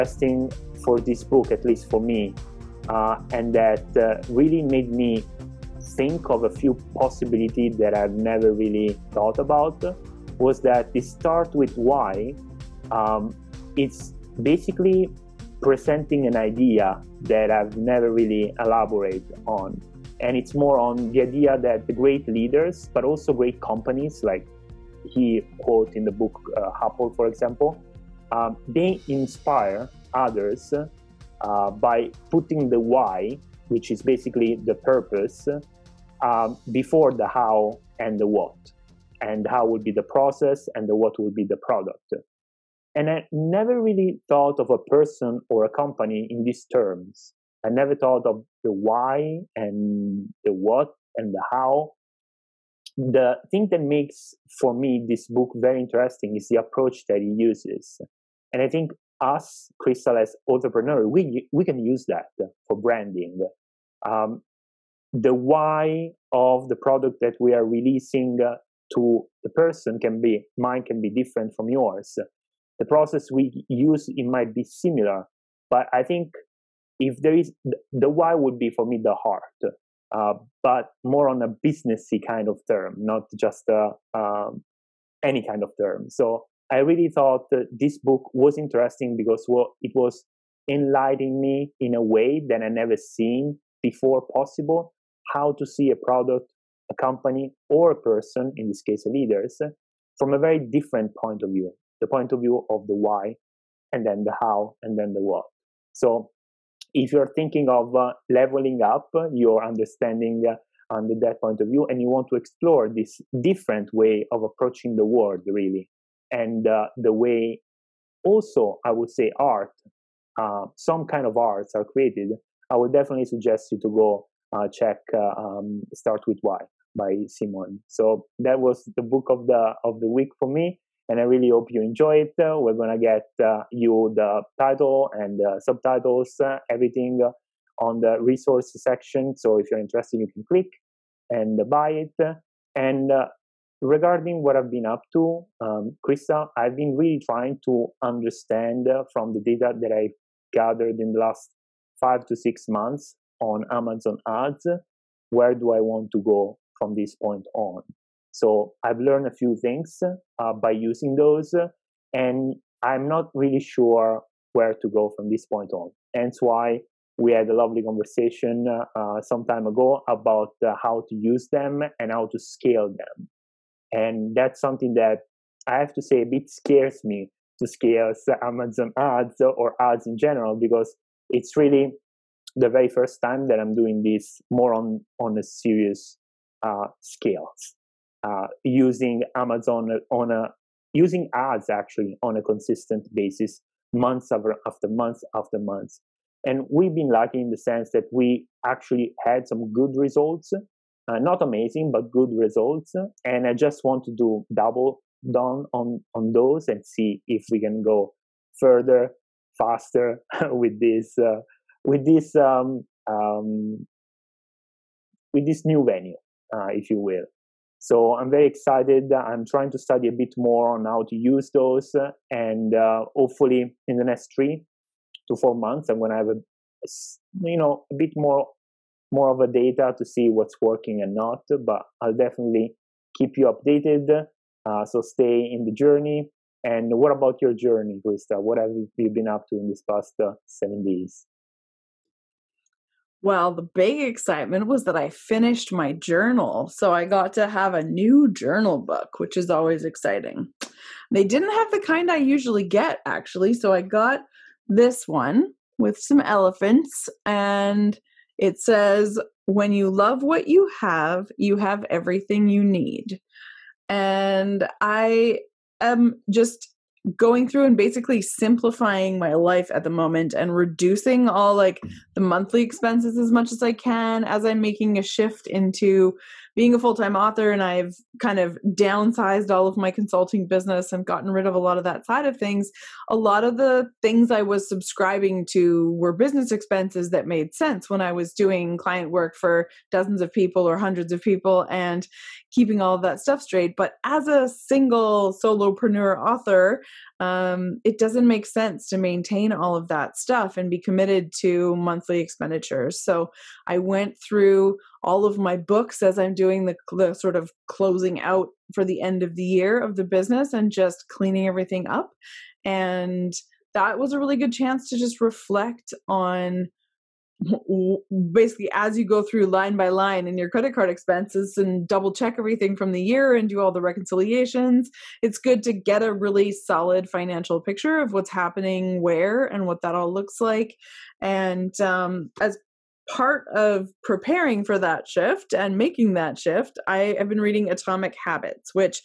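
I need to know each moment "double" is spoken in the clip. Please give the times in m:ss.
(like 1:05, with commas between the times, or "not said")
3:24, 5:21.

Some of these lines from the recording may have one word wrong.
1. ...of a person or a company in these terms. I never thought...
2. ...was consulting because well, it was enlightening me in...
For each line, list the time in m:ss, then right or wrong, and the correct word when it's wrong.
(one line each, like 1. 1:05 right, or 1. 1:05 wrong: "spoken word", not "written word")
1. 0:44 right
2. 1:28 wrong: "interesting", not "consulting".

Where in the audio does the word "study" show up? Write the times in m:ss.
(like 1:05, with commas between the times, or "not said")
3:39.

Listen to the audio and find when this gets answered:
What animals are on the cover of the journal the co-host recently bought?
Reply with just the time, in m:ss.
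4:16.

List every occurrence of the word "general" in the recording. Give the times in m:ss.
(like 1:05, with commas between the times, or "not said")
3:00.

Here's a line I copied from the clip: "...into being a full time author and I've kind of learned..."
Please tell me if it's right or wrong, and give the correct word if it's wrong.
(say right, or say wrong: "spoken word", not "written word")
wrong: "downsized", not "learned".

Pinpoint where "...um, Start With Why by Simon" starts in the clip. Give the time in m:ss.
2:05.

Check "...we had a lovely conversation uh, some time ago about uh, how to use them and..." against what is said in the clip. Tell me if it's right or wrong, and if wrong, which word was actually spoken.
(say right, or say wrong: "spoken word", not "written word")
right.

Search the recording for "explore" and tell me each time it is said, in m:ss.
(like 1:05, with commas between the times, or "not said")
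1:52.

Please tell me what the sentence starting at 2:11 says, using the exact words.
And I really hope you enjoy it.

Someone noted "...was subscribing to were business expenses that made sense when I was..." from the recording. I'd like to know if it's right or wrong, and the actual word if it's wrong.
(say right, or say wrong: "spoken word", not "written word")
right.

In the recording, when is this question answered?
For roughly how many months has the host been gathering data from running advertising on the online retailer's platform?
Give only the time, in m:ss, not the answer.
2:31.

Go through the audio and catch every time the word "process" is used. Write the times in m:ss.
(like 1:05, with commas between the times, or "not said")
0:40, 1:12.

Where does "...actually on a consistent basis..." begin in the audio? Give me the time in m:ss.
3:11.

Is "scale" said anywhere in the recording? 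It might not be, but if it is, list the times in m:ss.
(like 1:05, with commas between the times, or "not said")
2:52, 2:57.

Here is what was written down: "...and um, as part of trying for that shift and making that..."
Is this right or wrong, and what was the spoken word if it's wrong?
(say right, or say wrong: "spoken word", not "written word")
wrong: "preparing", not "trying".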